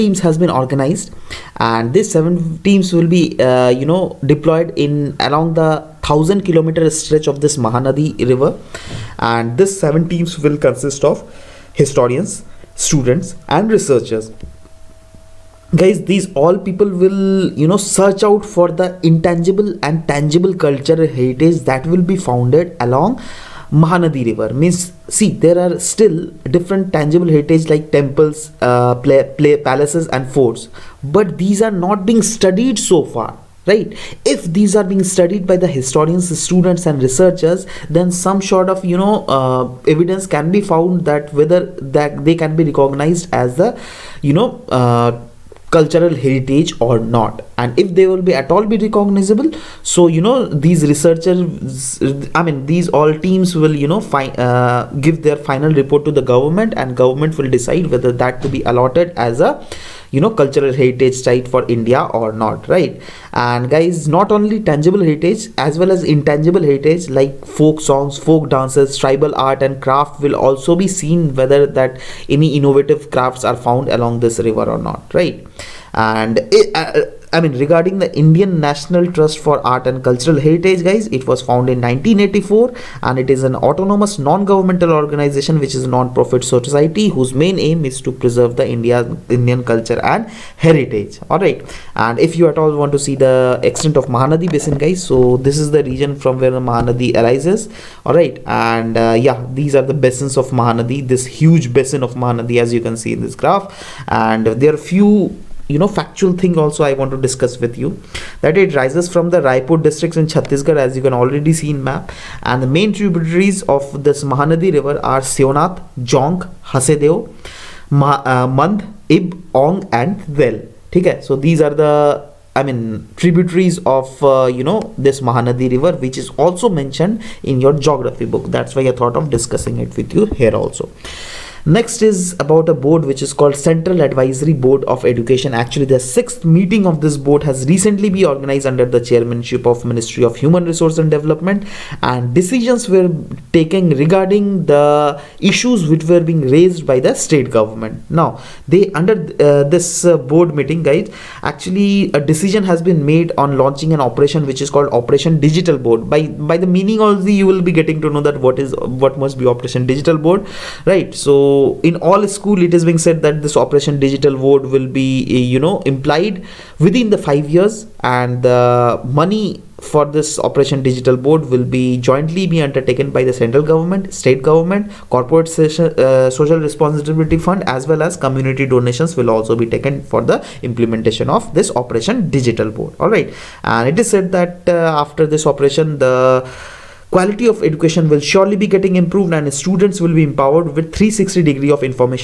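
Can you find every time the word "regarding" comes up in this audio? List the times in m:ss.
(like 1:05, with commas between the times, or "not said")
1:17, 2:23.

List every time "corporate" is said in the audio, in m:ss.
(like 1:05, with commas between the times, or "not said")
2:55.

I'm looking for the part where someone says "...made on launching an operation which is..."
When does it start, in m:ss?
2:33.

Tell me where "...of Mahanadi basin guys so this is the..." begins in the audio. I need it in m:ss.
1:33.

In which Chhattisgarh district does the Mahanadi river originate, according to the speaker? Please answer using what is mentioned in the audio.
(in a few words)
Raipur.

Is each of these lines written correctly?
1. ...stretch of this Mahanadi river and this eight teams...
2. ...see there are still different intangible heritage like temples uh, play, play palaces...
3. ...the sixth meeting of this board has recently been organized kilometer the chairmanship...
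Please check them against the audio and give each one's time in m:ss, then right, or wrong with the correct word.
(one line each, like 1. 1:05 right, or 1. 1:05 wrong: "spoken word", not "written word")
1. 0:06 wrong: "seven", not "eight"
2. 0:25 wrong: "tangible", not "intangible"
3. 2:15 wrong: "under", not "kilometer".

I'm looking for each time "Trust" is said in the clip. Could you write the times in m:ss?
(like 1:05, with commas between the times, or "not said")
1:19.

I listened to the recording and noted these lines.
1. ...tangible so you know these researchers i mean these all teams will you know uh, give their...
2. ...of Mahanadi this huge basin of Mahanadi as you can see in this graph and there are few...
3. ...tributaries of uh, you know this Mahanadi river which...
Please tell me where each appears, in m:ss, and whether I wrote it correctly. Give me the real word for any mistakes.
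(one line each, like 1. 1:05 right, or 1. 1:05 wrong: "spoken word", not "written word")
1. 0:48 wrong: "recognizable", not "tangible"
2. 1:40 right
3. 2:03 right.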